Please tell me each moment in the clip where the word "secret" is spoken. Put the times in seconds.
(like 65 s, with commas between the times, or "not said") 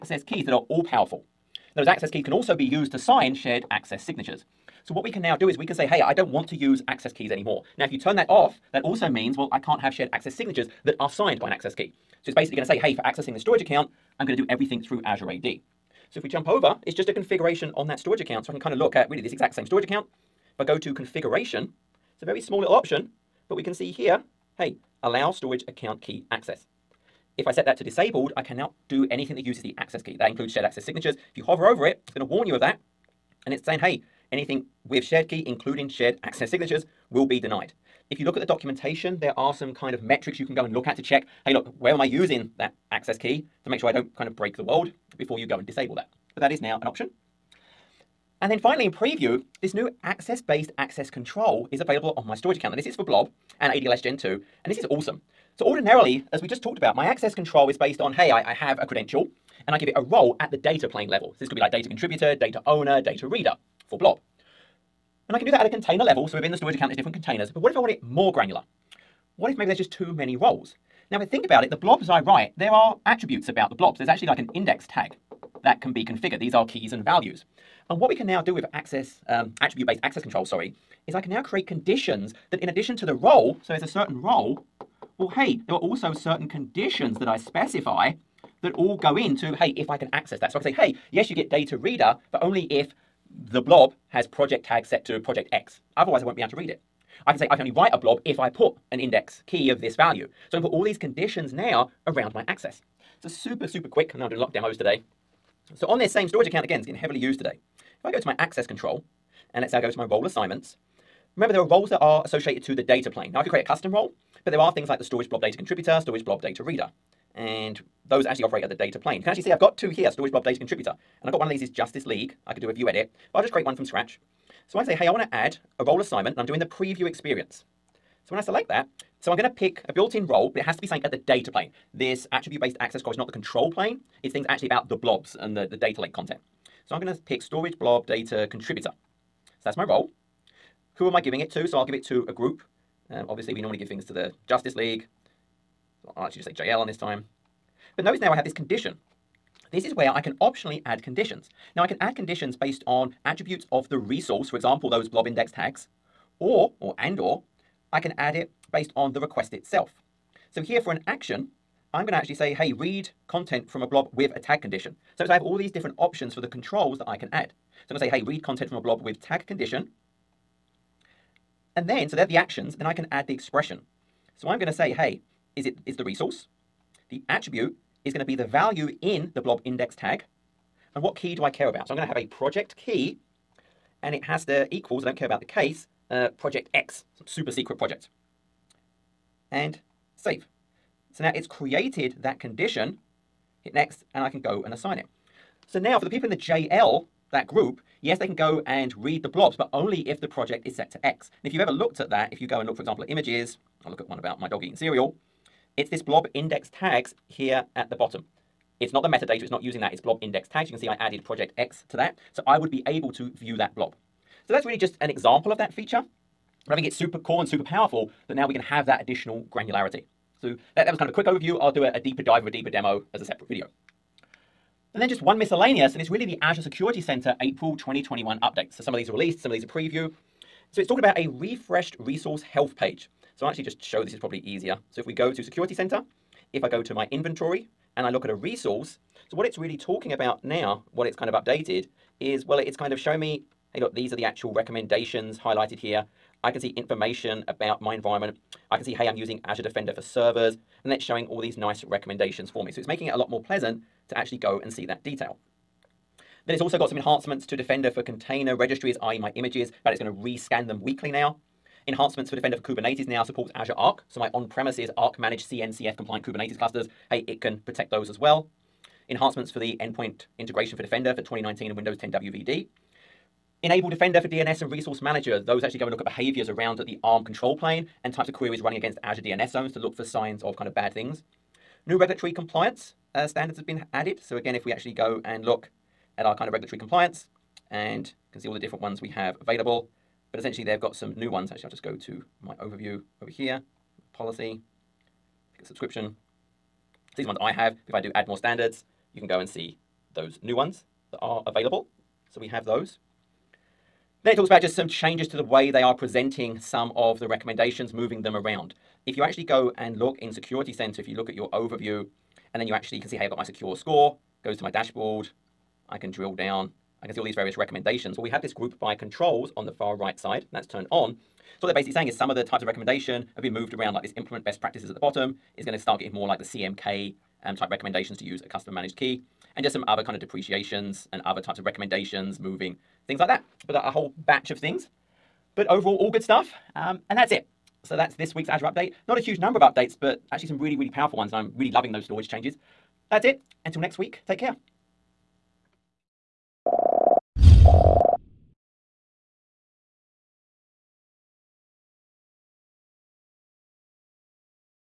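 187 s.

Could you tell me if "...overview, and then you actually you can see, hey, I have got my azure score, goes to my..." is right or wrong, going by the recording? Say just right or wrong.
wrong.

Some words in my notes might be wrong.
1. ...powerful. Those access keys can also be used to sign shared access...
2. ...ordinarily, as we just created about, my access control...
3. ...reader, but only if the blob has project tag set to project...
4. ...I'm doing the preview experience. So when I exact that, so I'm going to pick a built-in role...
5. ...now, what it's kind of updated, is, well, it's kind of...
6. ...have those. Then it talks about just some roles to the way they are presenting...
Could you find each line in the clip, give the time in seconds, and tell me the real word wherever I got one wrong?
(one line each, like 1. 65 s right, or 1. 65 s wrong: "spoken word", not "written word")
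1. 0 s right
2. 55 s wrong: "talked", not "created"
3. 91 s right
4. 126 s wrong: "select", not "exact"
5. 240 s right
6. 302 s wrong: "changes", not "roles".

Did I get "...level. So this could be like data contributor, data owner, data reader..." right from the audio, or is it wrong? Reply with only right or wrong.
right.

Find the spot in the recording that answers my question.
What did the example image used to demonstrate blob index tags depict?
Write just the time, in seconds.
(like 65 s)
204 s.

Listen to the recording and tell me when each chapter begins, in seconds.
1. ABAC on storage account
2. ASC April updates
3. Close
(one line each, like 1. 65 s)
1. 47 s
2. 225 s
3. 337 s.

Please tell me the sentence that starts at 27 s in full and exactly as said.
If I set that to disabled, I cannot do anything that uses the access key.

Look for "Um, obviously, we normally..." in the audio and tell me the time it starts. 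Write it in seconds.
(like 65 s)
143 s.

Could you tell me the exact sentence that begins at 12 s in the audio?
So it's basically going to say, hey, for accessing the storage account, I'm going to do everything through Azure AD.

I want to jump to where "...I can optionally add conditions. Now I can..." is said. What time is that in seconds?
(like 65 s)
150 s.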